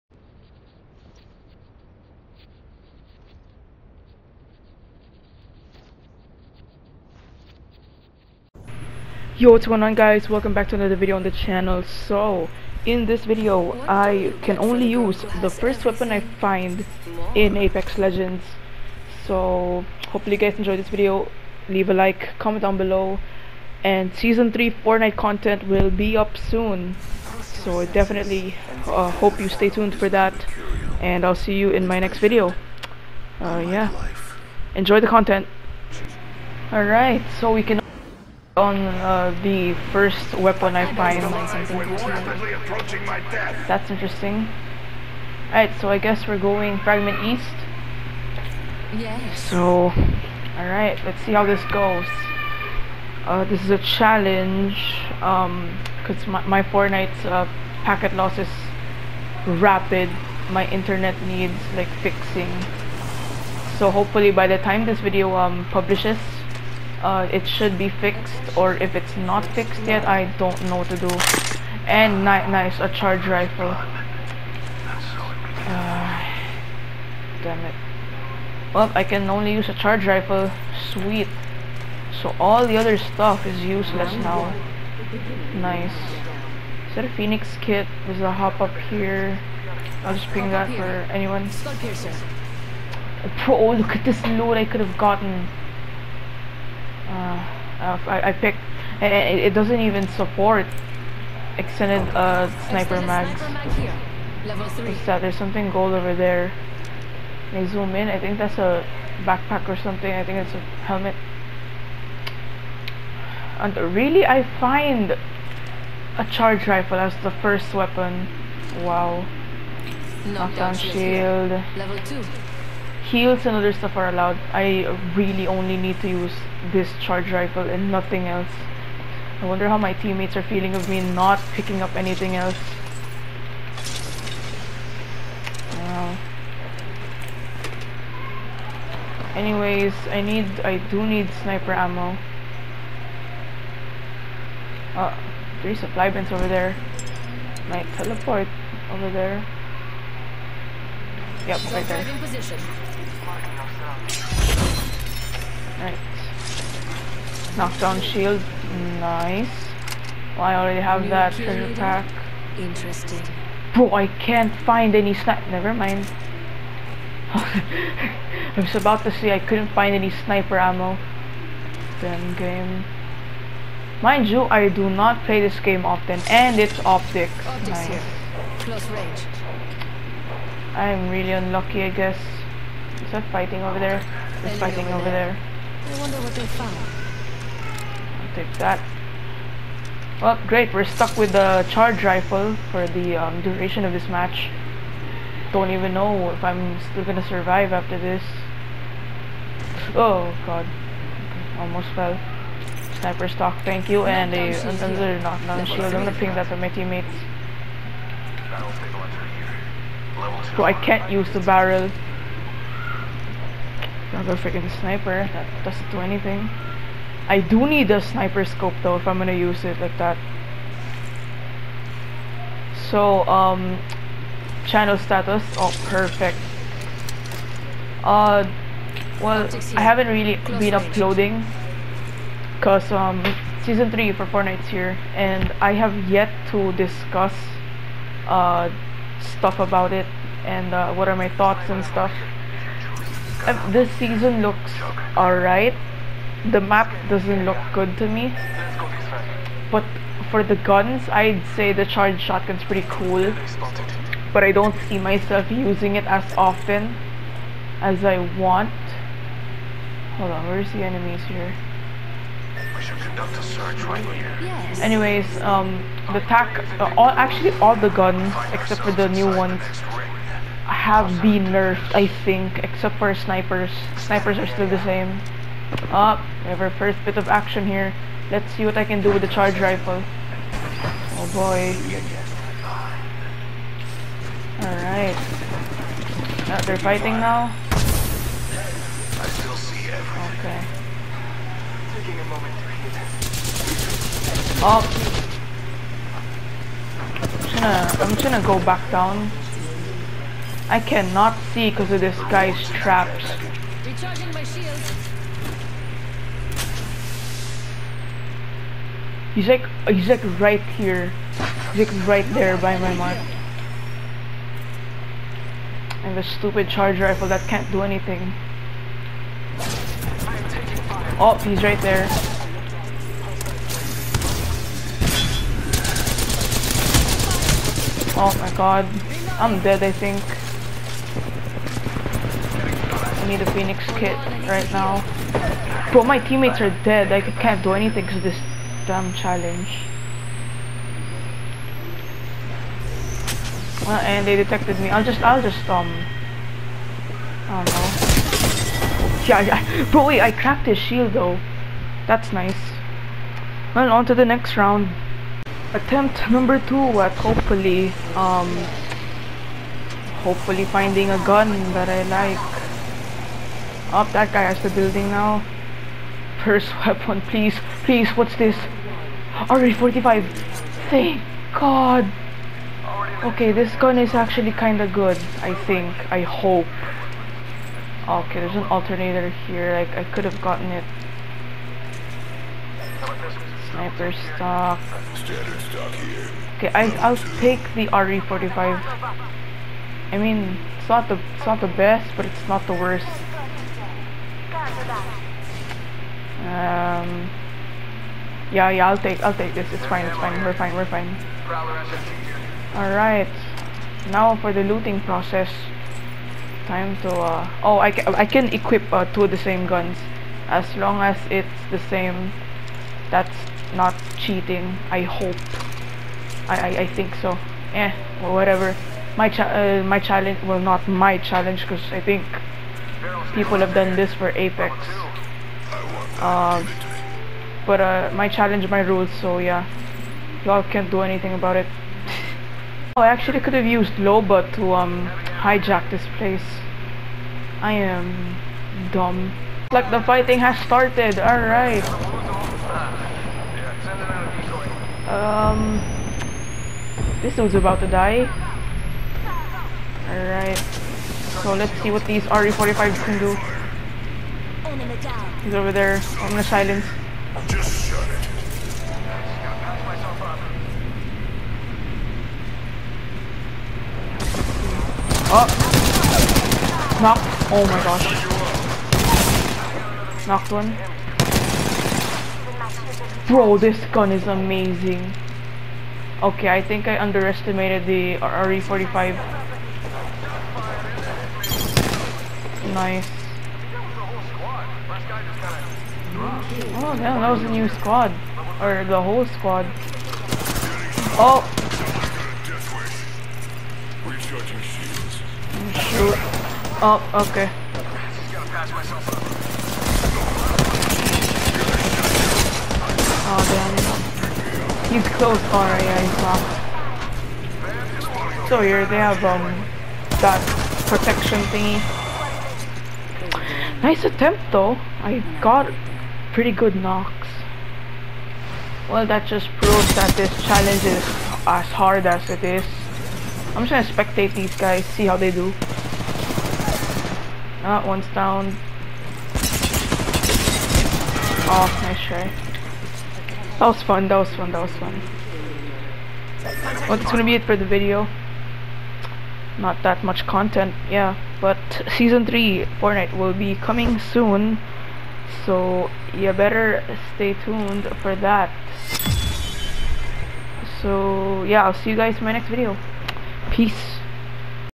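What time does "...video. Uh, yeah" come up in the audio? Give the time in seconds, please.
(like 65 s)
32 s.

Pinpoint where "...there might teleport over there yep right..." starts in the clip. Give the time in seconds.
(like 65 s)
146 s.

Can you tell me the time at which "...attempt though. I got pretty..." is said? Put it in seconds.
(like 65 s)
514 s.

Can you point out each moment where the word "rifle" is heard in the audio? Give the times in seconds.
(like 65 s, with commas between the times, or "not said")
73 s, 80 s, 116 s, 127 s, 192 s, 279 s, 317 s.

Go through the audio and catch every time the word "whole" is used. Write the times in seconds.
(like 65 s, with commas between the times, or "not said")
489 s.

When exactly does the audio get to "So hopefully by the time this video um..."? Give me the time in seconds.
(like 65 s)
63 s.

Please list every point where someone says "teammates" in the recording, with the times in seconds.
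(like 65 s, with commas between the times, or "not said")
129 s, 206 s, 336 s.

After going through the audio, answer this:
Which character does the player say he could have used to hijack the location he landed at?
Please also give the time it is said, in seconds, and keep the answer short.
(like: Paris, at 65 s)
Loba, at 433 s.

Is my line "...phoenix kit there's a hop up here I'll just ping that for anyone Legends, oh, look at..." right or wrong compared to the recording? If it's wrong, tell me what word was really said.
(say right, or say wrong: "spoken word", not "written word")
wrong: "Pro", not "Legends".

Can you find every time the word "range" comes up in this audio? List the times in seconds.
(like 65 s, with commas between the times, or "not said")
178 s, 230 s.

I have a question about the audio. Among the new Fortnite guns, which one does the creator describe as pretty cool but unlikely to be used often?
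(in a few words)
Charged shotgun.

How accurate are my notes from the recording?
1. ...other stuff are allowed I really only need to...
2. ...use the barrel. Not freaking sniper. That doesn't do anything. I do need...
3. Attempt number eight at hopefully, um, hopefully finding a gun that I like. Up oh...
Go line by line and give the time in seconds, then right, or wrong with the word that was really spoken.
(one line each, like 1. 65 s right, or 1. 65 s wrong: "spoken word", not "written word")
1. 123 s right
2. 211 s right
3. 355 s wrong: "two", not "eight".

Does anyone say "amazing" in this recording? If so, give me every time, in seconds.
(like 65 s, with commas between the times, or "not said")
474 s.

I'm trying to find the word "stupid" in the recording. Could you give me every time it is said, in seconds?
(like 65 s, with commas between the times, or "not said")
316 s.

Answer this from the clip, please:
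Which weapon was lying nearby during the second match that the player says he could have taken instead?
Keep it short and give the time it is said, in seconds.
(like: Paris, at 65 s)
Alternator, at 378 s.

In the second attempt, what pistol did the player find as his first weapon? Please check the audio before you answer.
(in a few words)
RE-45.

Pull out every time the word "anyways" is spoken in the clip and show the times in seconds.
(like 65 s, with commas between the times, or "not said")
139 s, 264 s.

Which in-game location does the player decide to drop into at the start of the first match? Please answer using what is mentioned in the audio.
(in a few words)
Fragment East.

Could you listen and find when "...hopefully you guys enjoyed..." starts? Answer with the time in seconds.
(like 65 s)
20 s.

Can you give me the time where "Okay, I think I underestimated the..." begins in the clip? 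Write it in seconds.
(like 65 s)
476 s.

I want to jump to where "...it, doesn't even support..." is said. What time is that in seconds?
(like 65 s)
99 s.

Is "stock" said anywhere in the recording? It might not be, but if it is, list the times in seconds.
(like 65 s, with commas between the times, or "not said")
203 s, 384 s.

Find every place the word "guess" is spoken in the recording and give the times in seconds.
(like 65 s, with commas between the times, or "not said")
45 s, 181 s.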